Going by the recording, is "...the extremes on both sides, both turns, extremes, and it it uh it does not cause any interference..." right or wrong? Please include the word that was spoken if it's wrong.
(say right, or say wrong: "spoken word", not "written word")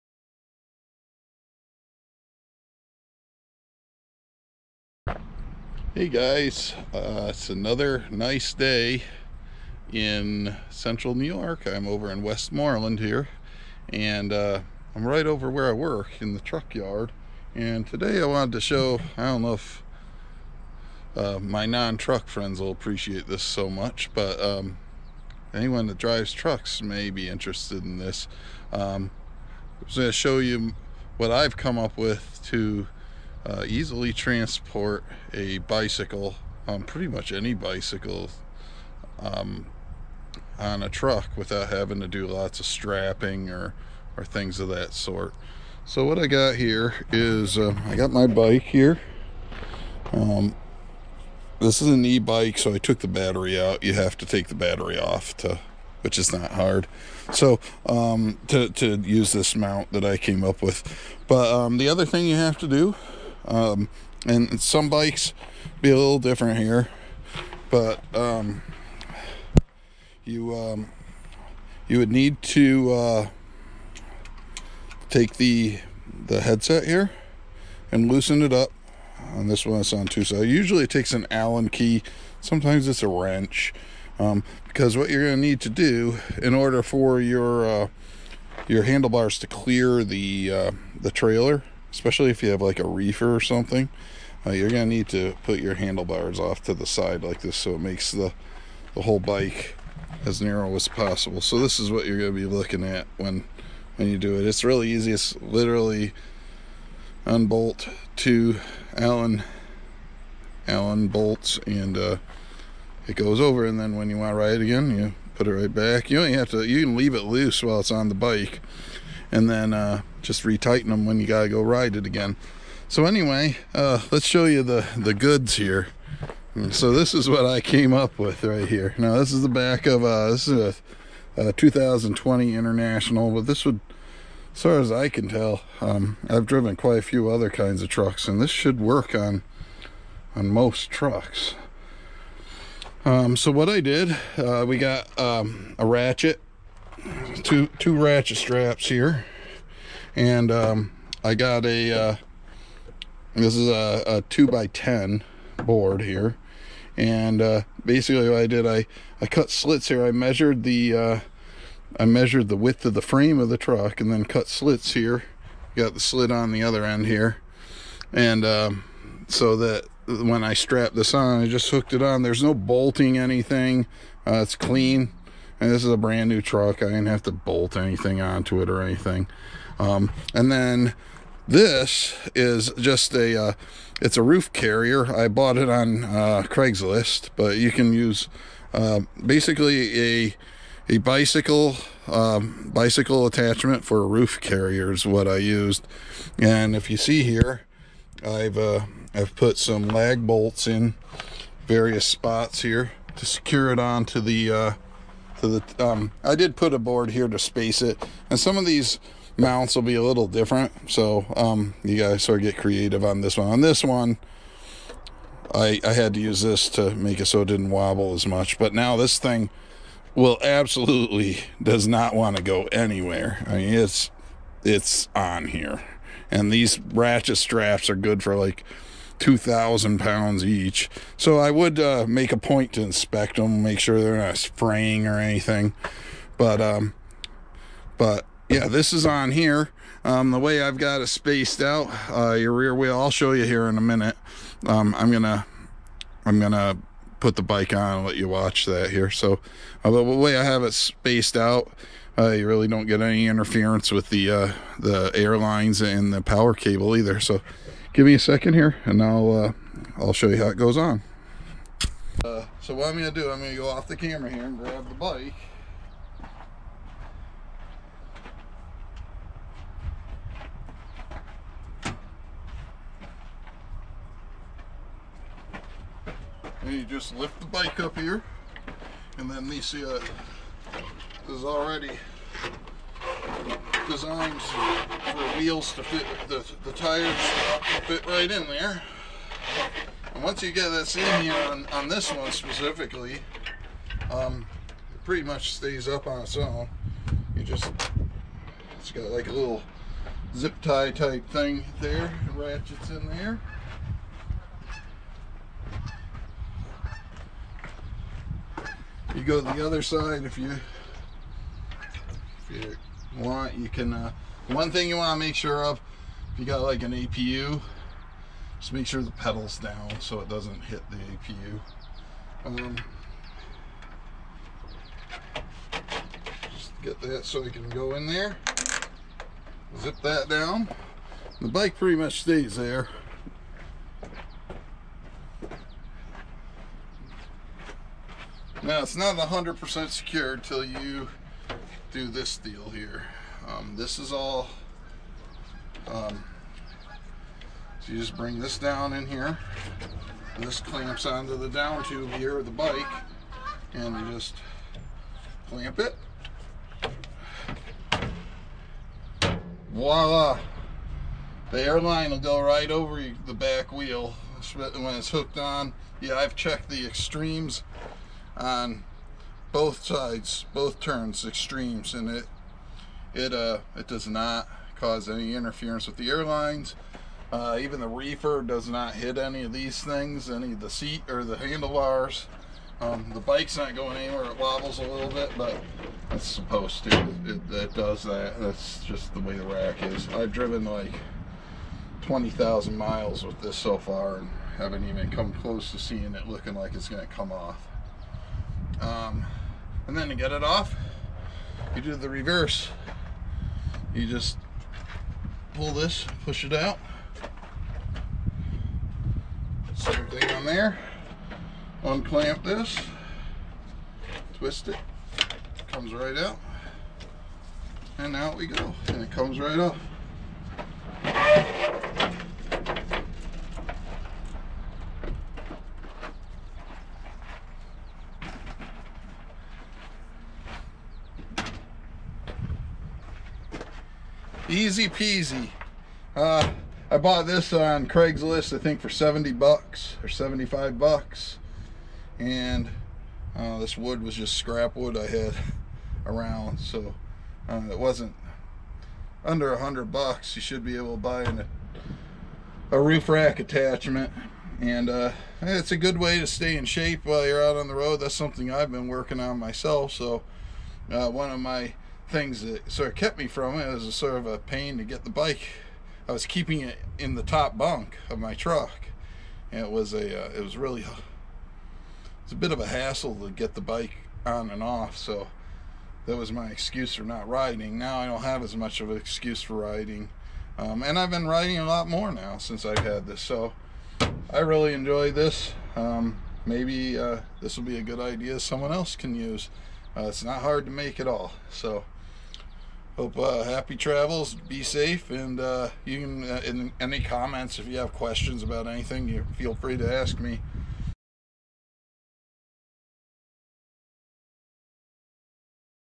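right.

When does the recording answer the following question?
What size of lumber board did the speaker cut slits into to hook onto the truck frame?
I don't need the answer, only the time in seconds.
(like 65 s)
154 s.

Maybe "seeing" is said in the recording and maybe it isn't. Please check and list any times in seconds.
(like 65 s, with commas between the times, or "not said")
395 s.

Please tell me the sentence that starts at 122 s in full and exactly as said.
So anyway, uh, let's show you the, the goods here.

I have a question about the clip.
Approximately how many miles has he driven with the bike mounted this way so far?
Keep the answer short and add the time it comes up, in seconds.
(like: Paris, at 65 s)
20,000, at 392 s.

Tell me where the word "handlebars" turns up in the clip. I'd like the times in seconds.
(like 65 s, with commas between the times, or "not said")
88 s, 95 s, 381 s.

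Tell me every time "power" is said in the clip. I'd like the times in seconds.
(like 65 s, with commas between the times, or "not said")
256 s.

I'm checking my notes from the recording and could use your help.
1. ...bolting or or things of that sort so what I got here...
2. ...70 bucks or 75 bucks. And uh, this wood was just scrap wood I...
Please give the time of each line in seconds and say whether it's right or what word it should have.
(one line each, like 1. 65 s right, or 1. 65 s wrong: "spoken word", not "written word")
1. 42 s wrong: "strapping", not "bolting"
2. 438 s right.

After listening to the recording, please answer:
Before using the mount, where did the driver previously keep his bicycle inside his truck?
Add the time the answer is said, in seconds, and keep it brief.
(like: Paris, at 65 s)
top bunk, at 467 s.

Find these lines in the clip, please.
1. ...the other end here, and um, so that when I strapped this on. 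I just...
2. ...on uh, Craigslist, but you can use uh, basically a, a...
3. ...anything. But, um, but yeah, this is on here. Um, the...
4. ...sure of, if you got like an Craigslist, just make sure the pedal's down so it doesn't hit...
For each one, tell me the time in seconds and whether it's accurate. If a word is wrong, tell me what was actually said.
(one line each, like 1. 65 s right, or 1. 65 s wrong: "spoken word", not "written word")
1. 166 s right
2. 185 s right
3. 235 s right
4. 315 s wrong: "APU", not "Craigslist".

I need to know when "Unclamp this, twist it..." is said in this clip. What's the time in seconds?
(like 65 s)
411 s.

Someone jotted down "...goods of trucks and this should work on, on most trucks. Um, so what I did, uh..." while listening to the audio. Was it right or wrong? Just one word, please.
wrong.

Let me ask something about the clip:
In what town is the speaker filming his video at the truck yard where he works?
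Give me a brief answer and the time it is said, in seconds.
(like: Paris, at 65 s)
Westmoreland, at 12 s.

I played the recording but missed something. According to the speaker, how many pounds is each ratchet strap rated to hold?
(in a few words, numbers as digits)
2,000.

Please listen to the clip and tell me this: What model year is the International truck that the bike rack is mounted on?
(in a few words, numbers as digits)
2020.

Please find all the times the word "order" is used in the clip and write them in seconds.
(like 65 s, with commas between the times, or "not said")
86 s.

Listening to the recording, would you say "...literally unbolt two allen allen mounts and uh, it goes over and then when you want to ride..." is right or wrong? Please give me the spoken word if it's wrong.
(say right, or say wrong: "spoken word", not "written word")
wrong: "bolts", not "mounts".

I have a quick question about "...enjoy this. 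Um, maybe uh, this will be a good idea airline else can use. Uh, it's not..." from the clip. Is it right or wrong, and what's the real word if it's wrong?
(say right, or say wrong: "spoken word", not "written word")
wrong: "someone", not "airline".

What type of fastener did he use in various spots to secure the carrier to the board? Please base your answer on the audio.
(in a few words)
lag bolts.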